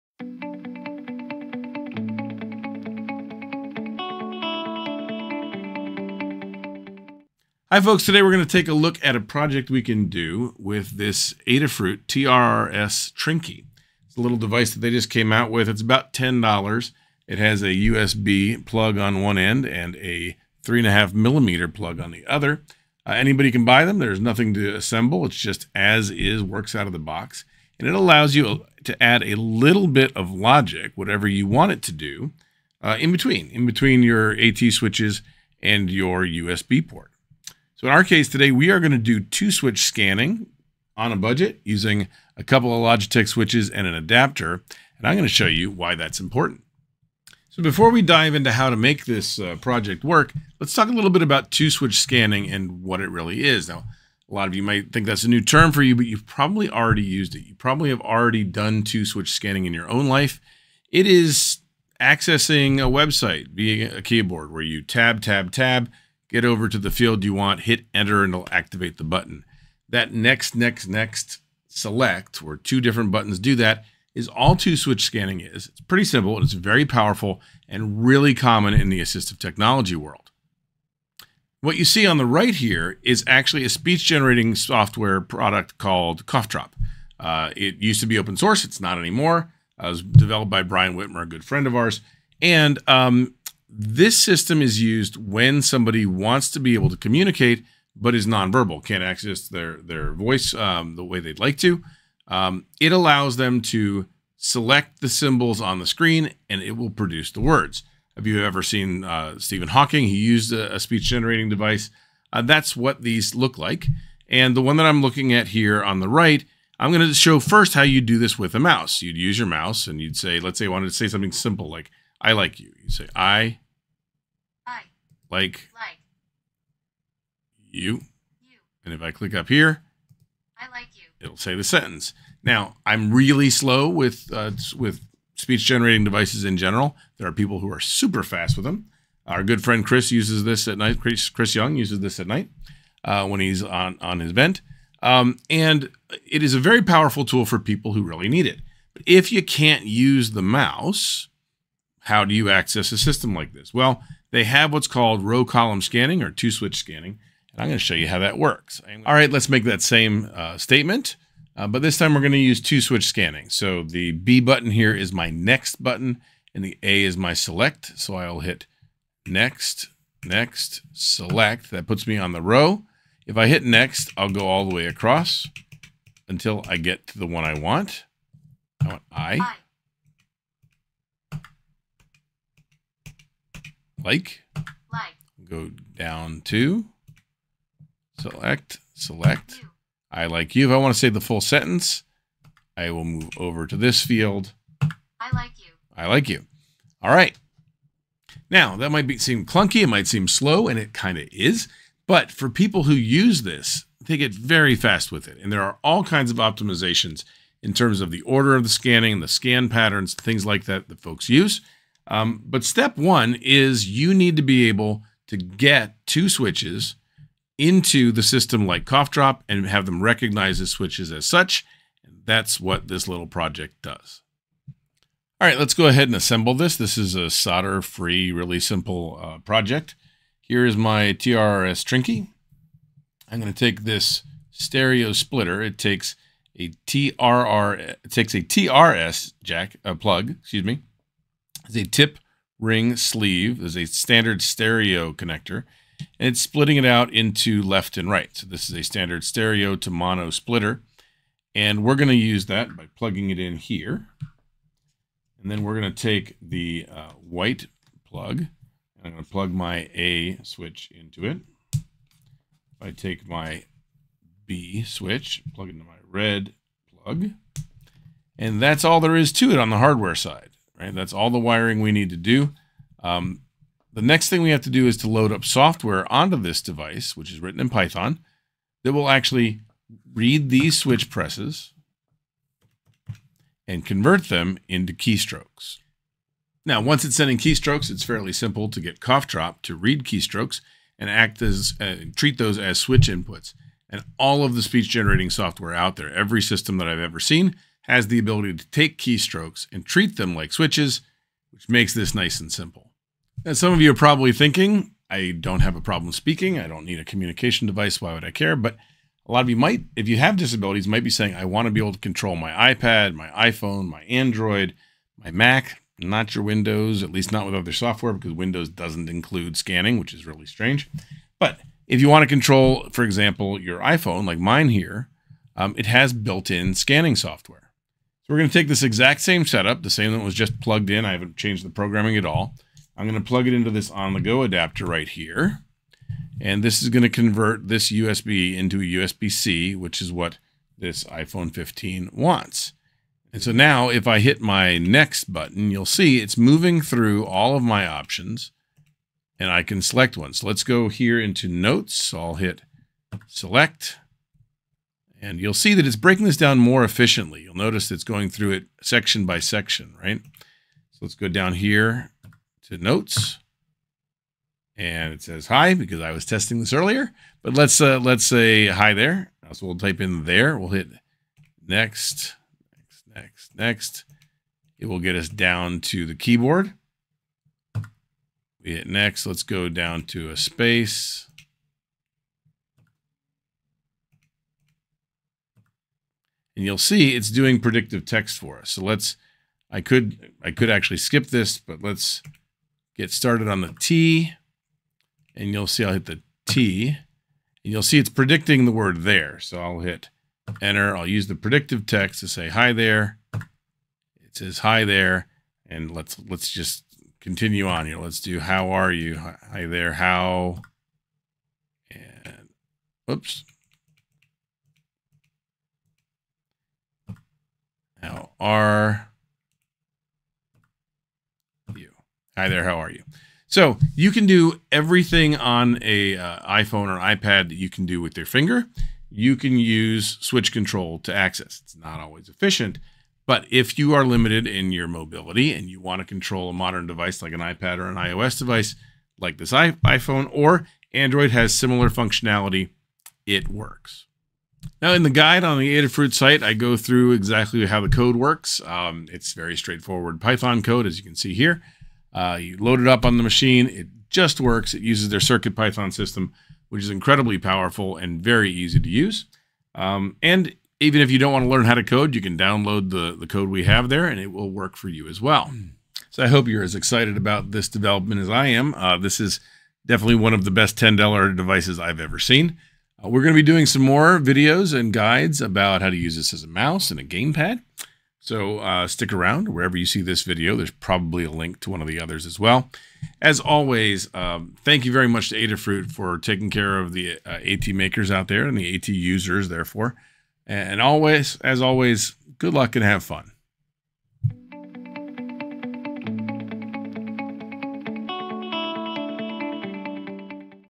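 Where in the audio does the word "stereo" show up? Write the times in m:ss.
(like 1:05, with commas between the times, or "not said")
3:54, 4:04, 4:09.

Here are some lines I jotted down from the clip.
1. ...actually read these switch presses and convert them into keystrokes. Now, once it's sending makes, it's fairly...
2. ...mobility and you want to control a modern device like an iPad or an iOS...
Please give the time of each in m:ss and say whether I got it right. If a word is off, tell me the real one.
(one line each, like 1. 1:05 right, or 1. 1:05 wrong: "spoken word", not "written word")
1. 4:39 wrong: "keystrokes", not "makes"
2. 7:14 right.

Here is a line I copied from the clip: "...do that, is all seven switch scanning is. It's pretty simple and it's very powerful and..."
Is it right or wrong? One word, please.
wrong.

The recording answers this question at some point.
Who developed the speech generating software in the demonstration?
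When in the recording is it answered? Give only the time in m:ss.
1:30.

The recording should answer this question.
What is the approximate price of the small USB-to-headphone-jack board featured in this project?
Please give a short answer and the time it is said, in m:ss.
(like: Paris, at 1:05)
$10, at 0:15.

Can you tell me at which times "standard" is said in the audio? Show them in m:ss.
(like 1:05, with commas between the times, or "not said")
4:03, 4:08.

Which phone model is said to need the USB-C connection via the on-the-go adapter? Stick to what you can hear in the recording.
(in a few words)
iPhone 15.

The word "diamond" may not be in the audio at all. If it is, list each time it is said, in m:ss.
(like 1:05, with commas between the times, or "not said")
not said.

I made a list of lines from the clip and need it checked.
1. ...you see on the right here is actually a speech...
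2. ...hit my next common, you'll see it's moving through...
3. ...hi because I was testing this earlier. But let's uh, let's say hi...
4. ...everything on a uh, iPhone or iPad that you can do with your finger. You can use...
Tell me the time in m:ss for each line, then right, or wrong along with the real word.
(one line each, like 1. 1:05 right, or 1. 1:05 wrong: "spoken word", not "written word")
1. 1:21 right
2. 5:44 wrong: "button", not "common"
3. 6:05 right
4. 7:04 right.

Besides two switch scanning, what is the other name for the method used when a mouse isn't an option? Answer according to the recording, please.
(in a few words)
row column scanning.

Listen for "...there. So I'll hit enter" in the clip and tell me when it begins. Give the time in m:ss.
6:39.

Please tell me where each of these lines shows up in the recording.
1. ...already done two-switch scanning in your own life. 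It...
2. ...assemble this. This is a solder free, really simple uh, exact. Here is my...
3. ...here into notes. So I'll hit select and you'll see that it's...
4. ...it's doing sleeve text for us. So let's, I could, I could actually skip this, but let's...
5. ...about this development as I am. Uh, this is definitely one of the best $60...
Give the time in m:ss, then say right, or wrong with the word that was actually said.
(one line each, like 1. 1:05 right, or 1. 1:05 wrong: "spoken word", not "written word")
1. 0:58 right
2. 3:46 wrong: "project", not "exact"
3. 5:50 right
4. 6:27 wrong: "predictive", not "sleeve"
5. 7:47 wrong: "10", not "60".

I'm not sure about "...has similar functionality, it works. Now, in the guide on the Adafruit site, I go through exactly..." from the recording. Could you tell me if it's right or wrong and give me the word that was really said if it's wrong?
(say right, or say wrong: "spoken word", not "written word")
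right.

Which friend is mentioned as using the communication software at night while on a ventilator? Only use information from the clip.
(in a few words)
Chris Young.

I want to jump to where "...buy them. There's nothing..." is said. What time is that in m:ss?
0:23.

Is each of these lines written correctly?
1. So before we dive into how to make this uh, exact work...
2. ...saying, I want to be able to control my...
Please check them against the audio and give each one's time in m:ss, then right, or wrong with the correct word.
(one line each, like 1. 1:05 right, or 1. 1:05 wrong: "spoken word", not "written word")
1. 0:47 wrong: "project", not "exact"
2. 5:11 right.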